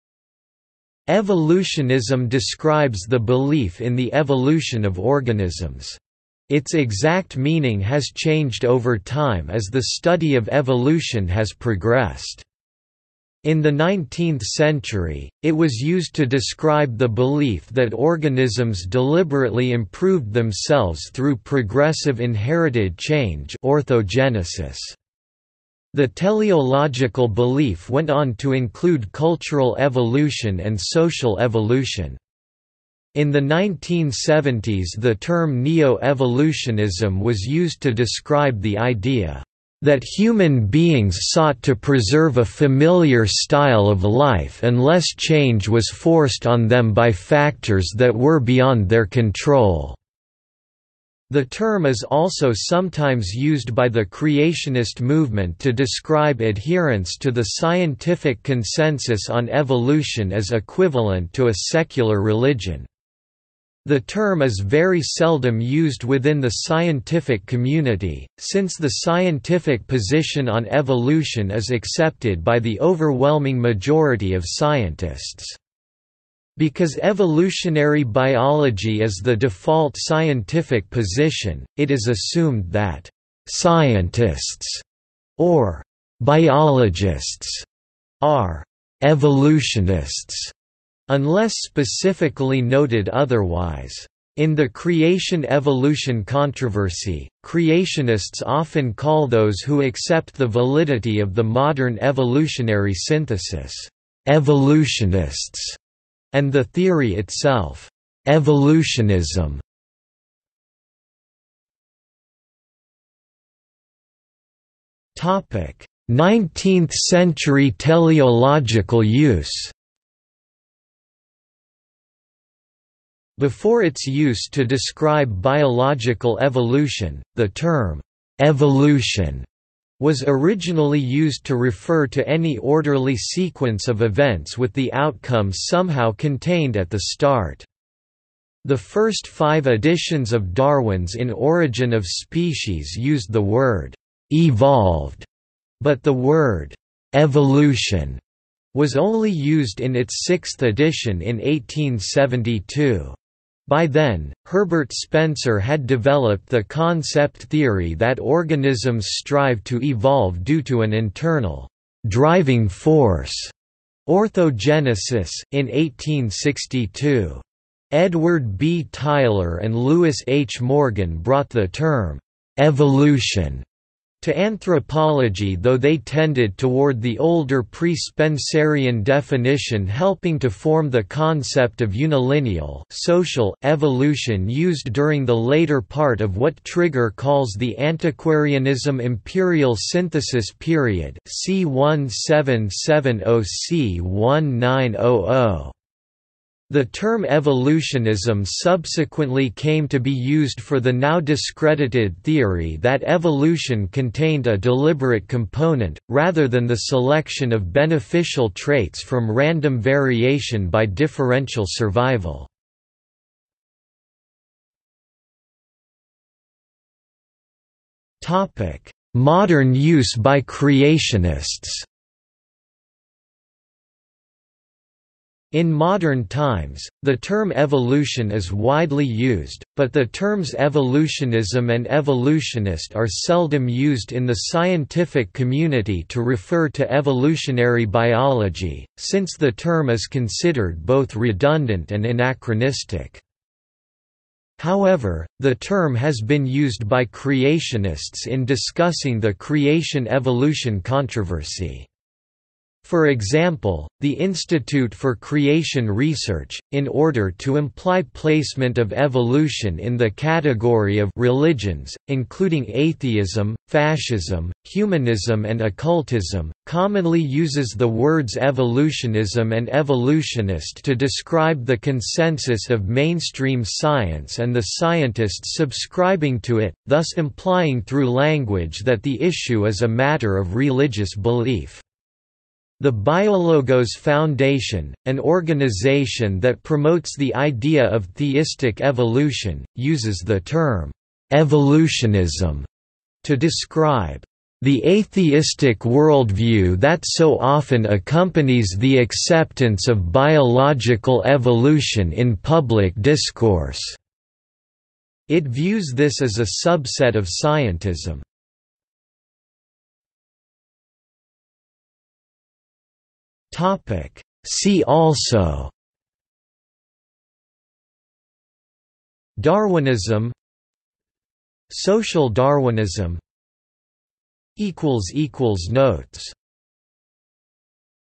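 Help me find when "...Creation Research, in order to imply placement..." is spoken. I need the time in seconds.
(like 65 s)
255 s.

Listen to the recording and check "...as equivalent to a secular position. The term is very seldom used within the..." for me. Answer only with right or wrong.
wrong.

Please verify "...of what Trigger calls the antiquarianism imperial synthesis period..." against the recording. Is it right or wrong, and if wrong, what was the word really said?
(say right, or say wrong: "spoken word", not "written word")
right.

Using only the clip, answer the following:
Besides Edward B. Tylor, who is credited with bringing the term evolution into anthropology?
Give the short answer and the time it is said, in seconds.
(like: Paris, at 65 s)
Lewis H. Morgan, at 169 s.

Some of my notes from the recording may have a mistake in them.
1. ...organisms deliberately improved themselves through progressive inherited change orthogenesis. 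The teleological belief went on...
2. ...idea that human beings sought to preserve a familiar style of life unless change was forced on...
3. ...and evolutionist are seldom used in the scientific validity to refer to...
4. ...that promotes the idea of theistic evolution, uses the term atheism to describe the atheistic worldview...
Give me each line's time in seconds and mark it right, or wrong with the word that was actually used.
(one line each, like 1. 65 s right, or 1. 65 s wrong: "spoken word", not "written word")
1. 17 s right
2. 38 s right
3. 231 s wrong: "community", not "validity"
4. 286 s wrong: "evolutionism", not "atheism".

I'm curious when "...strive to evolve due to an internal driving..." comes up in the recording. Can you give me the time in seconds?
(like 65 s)
159 s.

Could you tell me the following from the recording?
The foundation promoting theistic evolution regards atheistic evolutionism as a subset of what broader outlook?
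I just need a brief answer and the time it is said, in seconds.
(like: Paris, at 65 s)
scientism, at 307 s.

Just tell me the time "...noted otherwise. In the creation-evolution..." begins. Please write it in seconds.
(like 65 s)
92 s.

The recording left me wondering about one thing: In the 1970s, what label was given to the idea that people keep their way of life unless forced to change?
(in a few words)
neo-evolutionism.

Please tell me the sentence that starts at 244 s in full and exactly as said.
However, the term has been used by creationists in discussing the creation-evolution controversy.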